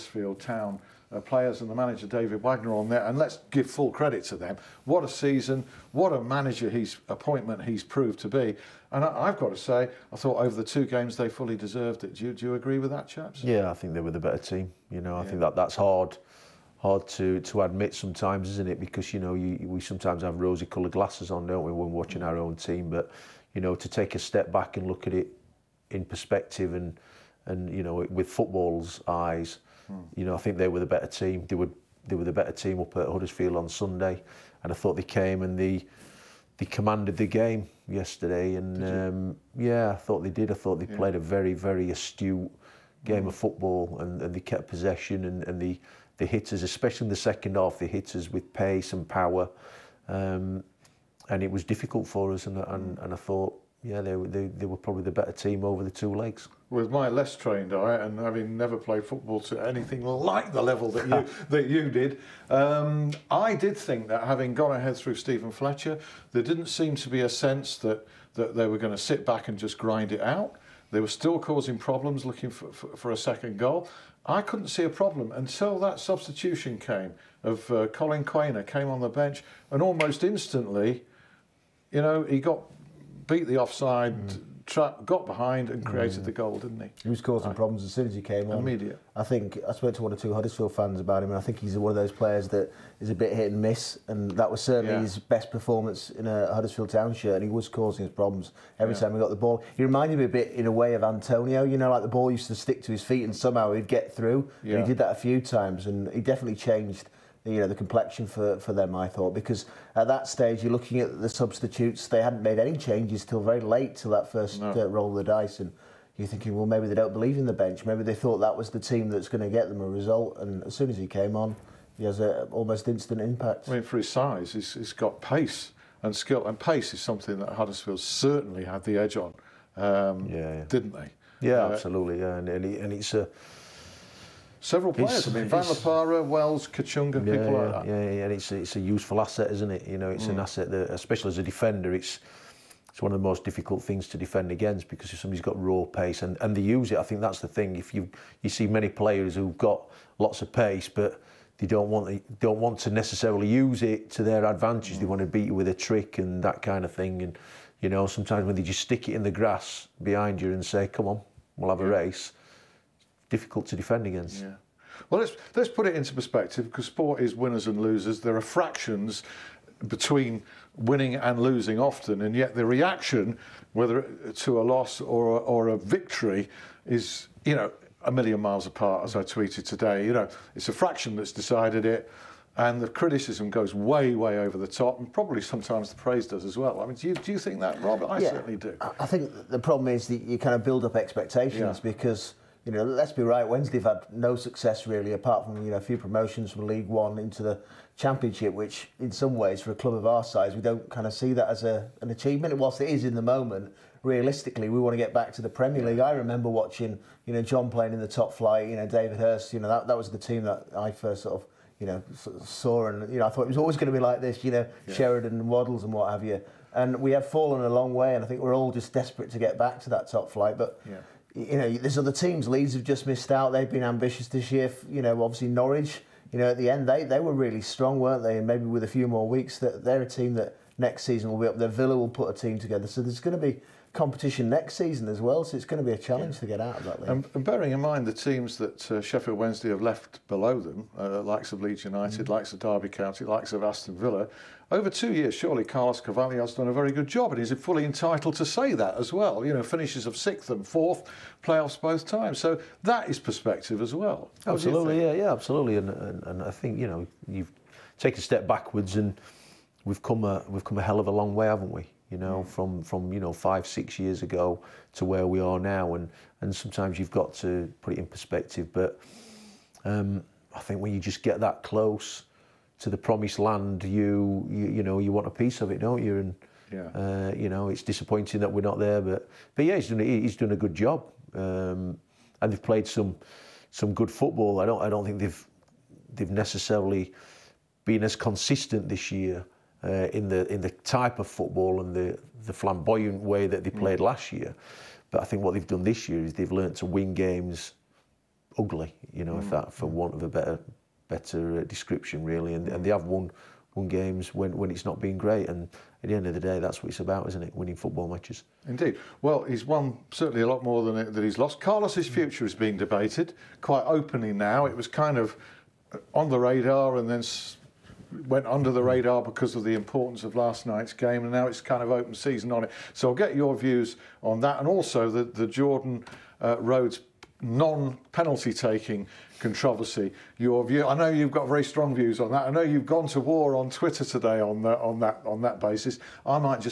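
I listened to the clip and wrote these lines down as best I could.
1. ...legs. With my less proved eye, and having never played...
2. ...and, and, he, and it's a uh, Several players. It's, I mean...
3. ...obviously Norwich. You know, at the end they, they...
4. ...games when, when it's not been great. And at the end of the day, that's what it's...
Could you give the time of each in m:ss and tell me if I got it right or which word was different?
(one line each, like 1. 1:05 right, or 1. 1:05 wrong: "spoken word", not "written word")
1. 0:56 wrong: "trained", not "proved"
2. 2:12 right
3. 3:45 right
4. 5:03 right.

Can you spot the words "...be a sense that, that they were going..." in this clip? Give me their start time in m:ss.
1:07.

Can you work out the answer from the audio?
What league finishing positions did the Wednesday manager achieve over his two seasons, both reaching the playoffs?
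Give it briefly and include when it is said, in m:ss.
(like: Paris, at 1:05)
6th and 4th, at 4:10.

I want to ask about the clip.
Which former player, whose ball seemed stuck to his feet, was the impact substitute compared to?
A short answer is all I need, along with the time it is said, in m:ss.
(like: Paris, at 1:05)
Antonio, at 1:41.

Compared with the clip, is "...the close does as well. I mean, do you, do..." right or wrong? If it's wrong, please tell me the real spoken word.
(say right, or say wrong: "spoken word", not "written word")
wrong: "praise", not "close".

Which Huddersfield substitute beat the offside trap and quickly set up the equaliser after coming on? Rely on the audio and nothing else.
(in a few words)
Collin Quaner.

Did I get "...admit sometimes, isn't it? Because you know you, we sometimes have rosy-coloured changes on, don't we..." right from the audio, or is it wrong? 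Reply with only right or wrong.
wrong.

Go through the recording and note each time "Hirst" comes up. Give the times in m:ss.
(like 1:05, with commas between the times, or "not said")
3:29.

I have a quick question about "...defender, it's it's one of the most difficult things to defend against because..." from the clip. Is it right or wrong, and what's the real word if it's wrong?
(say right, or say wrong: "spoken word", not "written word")
right.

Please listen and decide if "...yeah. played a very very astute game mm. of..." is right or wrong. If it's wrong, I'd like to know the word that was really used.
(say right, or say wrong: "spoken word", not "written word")
right.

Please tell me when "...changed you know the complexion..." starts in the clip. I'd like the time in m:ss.
1:46.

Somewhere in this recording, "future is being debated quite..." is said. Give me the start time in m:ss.
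5:12.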